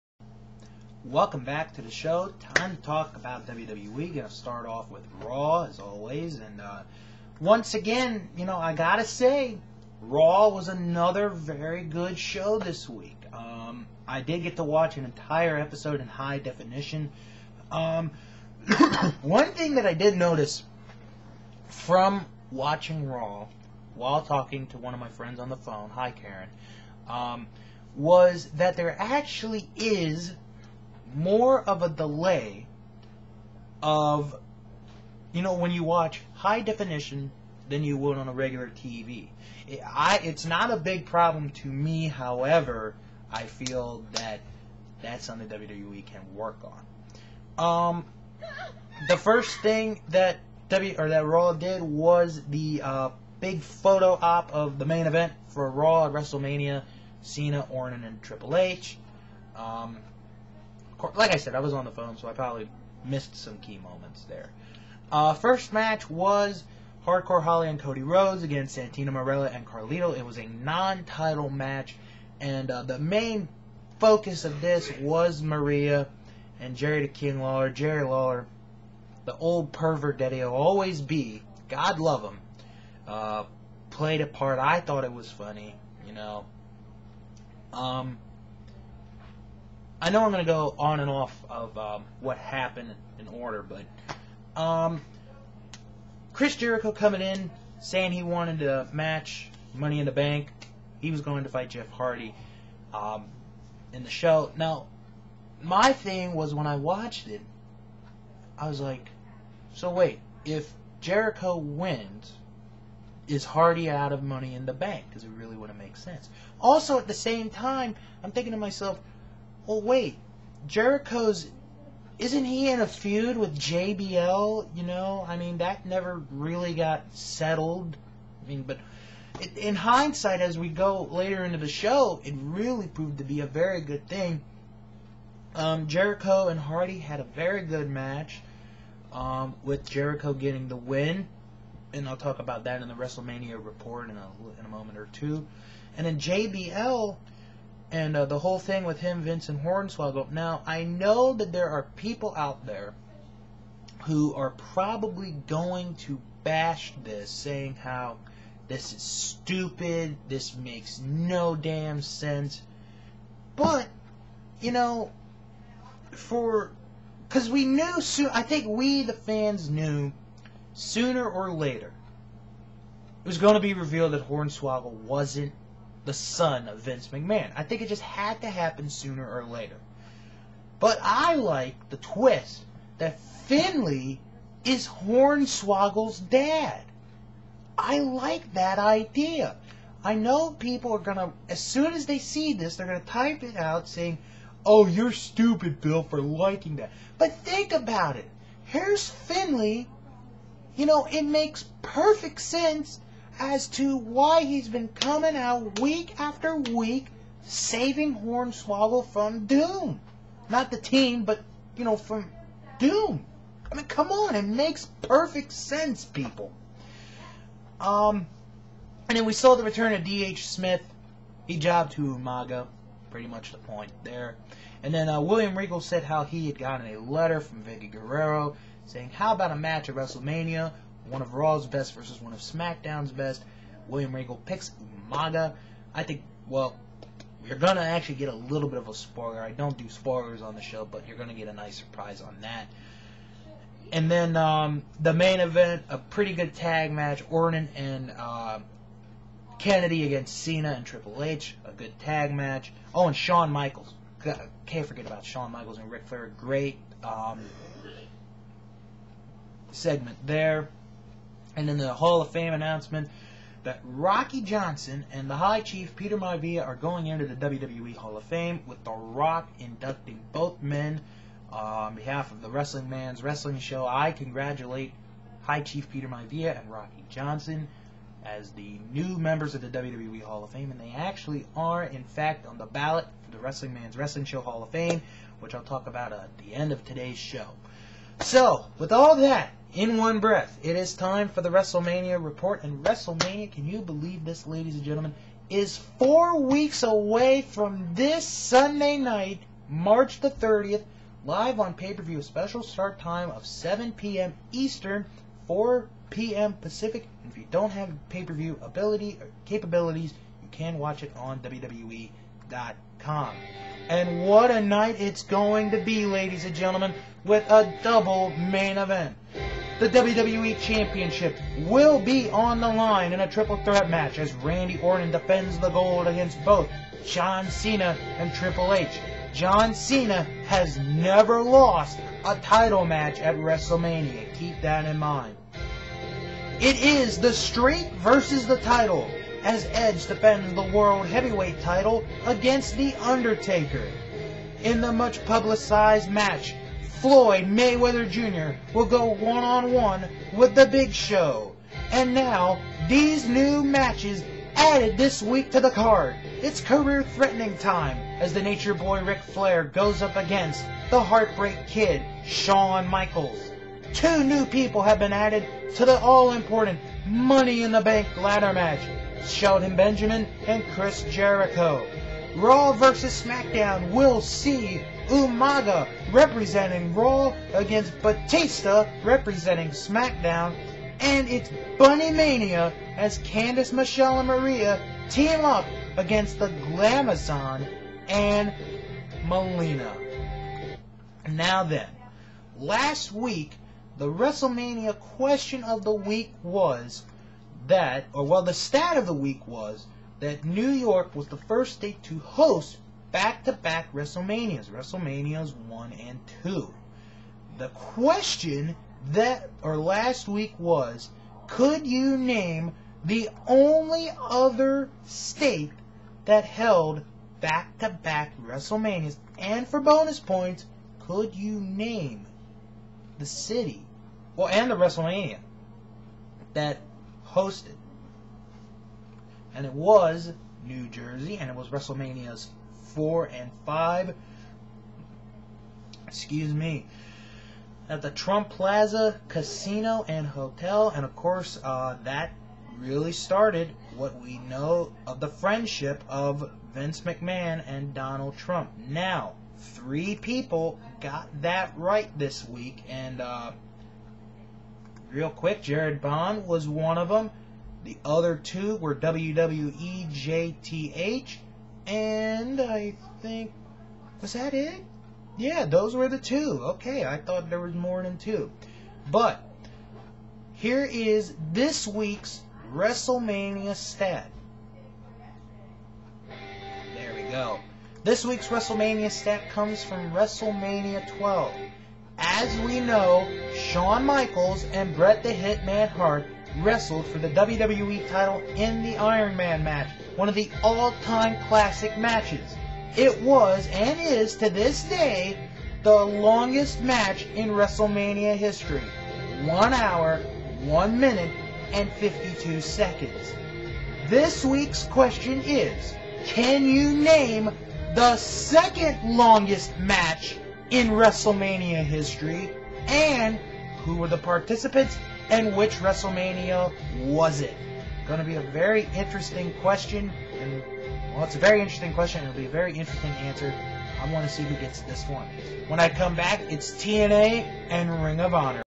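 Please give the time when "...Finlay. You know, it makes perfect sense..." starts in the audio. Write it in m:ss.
3:19.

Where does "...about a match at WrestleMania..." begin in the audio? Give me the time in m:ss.
3:49.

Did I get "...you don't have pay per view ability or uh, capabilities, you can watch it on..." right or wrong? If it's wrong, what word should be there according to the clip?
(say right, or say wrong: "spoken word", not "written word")
right.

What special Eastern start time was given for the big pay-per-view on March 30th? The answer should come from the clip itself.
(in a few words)
7 p.m.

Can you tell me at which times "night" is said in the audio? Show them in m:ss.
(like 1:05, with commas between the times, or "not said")
4:58, 5:14.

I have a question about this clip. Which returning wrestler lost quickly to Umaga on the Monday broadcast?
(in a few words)
D.H. 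Smith.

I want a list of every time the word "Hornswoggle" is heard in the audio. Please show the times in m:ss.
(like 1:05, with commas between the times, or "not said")
2:29, 2:54, 3:04, 3:28.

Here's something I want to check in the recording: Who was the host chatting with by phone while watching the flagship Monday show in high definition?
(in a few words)
Karen.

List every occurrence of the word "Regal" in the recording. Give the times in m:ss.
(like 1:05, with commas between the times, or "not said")
3:45, 3:54.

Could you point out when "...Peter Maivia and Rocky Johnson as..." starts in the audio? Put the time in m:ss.
4:35.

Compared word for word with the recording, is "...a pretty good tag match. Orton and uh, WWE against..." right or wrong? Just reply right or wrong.
wrong.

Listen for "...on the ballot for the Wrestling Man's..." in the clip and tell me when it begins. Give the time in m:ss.
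4:42.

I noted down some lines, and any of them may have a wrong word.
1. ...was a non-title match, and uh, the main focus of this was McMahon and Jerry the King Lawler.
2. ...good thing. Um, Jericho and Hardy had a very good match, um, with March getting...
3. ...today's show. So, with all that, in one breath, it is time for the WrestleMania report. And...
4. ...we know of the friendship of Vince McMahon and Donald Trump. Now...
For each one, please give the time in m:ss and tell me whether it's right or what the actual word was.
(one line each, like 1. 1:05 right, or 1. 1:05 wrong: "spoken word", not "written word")
1. 1:10 wrong: "Maria", not "McMahon"
2. 2:13 wrong: "Jericho", not "March"
3. 4:46 right
4. 7:24 right.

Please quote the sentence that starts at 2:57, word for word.
I think it just had to happen sooner or later.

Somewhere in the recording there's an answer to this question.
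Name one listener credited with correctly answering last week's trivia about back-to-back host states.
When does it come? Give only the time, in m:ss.
7:35.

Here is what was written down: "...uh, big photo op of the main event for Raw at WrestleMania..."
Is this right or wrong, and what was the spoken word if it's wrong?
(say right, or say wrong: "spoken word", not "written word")
right.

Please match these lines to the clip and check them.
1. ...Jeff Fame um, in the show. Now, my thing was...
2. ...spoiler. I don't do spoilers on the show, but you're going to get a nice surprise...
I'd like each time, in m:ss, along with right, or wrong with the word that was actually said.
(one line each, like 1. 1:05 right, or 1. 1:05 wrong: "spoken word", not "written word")
1. 1:41 wrong: "Hardy", not "Fame"
2. 3:58 right.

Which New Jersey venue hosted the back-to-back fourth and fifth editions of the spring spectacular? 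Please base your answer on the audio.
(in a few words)
Trump Plaza Casino and Hotel.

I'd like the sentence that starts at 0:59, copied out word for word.
Um, course, like I said, I was on the phone, so I probably missed some key moments there.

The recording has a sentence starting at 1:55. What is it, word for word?
Because it really wouldn't make sense.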